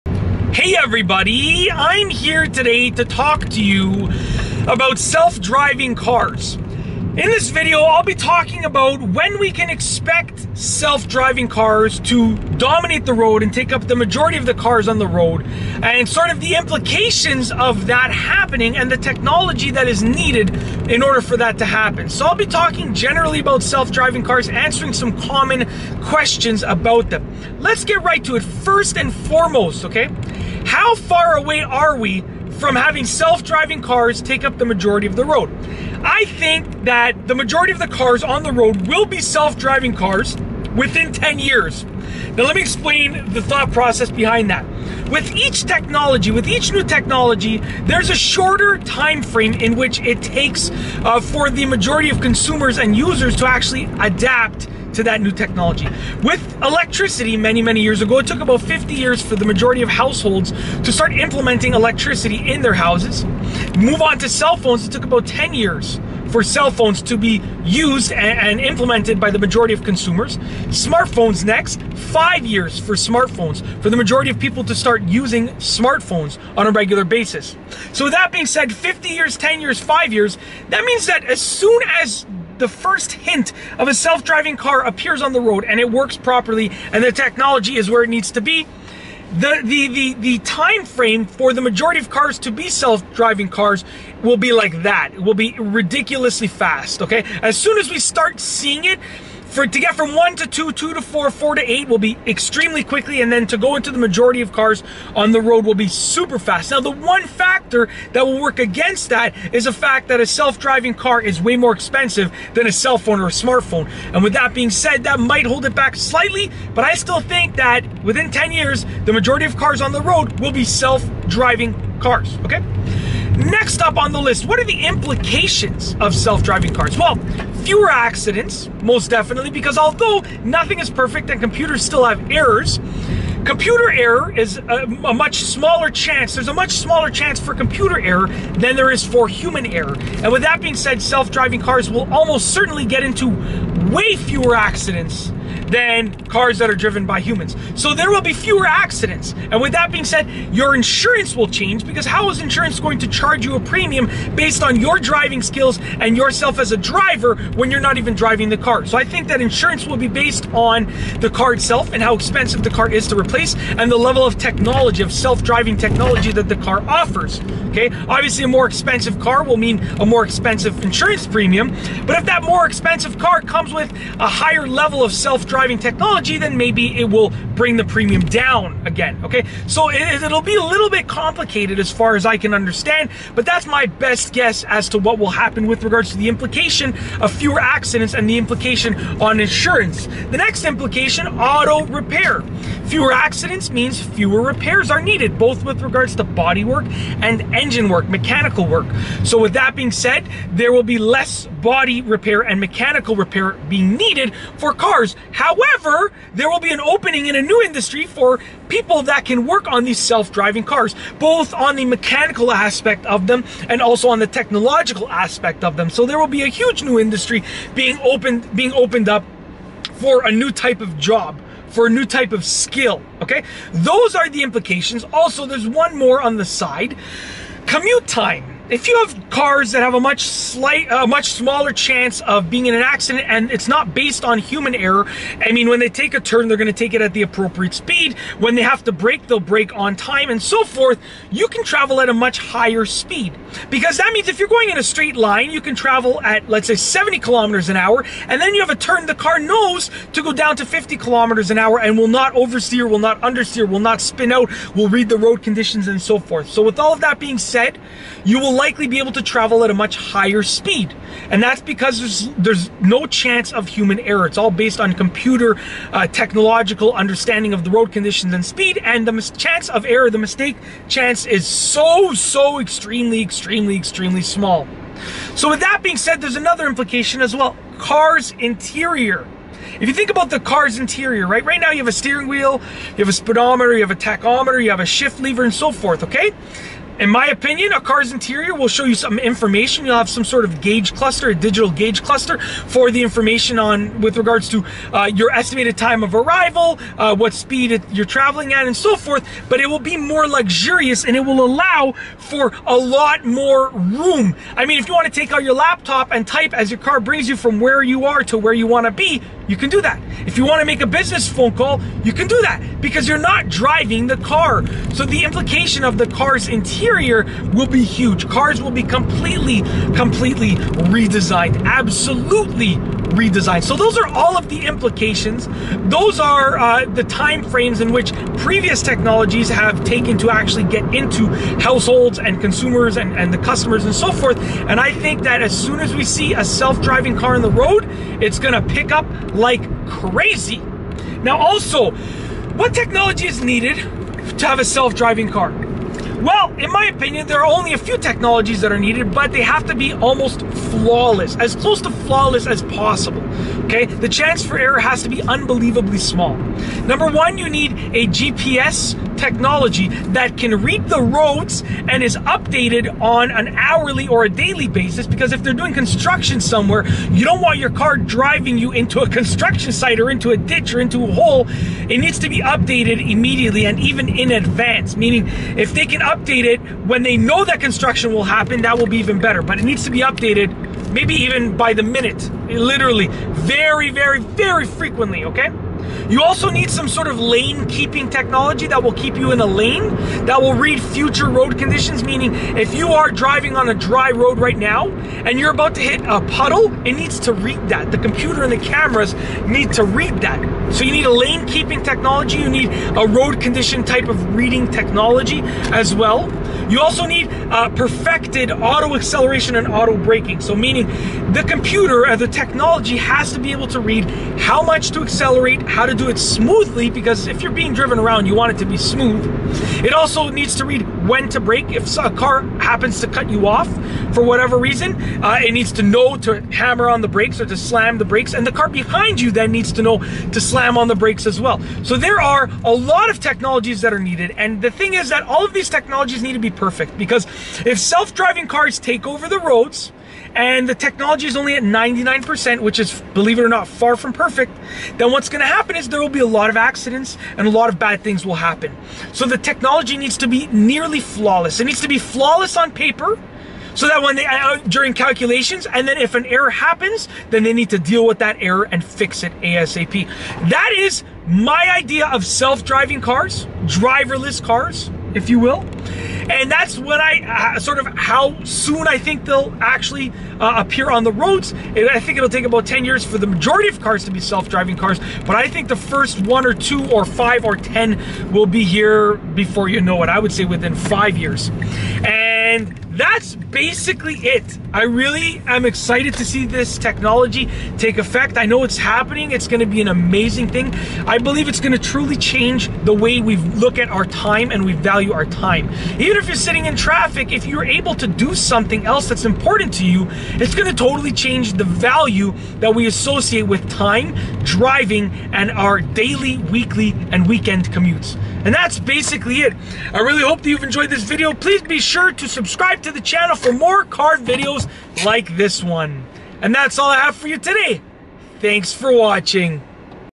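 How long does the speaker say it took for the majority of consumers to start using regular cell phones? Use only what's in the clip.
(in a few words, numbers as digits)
10 years.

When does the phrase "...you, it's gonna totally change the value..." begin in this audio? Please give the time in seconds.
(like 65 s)
499 s.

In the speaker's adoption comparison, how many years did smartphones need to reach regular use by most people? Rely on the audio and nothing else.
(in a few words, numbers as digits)
5 years.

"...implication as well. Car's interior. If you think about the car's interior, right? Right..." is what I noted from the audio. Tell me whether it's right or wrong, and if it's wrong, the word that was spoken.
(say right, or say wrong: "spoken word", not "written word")
right.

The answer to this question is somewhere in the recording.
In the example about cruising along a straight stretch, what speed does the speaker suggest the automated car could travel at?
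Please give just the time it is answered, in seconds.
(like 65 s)
246 s.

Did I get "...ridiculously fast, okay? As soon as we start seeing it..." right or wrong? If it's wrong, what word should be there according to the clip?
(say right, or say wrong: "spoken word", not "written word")
right.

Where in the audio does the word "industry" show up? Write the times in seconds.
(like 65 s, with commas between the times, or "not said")
207 s, 216 s.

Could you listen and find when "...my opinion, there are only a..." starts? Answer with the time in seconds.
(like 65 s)
346 s.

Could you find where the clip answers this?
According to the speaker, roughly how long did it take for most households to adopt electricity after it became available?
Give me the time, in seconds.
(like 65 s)
58 s.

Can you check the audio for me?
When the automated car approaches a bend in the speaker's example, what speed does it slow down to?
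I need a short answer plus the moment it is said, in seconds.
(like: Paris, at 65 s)
50 km/h, at 250 s.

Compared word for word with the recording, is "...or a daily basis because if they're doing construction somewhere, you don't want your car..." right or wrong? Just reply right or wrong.
right.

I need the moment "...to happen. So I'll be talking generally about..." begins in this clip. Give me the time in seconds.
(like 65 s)
21 s.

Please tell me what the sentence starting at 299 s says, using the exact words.
But it will be more luxurious and it will allow for a lot more room.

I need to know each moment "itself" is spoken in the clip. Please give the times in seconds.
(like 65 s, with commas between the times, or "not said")
161 s.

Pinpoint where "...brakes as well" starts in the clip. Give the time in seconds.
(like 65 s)
430 s.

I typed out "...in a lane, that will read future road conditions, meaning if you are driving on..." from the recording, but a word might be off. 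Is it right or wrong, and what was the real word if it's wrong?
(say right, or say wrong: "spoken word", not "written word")
right.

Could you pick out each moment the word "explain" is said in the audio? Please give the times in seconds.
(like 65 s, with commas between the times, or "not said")
42 s.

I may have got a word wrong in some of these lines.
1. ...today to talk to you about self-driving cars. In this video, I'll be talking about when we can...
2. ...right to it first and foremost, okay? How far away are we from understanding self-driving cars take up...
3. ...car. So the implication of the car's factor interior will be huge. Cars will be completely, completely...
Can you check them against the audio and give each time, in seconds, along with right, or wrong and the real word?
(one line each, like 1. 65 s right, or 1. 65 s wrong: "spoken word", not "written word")
1. 2 s right
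2. 28 s wrong: "having", not "understanding"
3. 314 s wrong: "interior", not "factor".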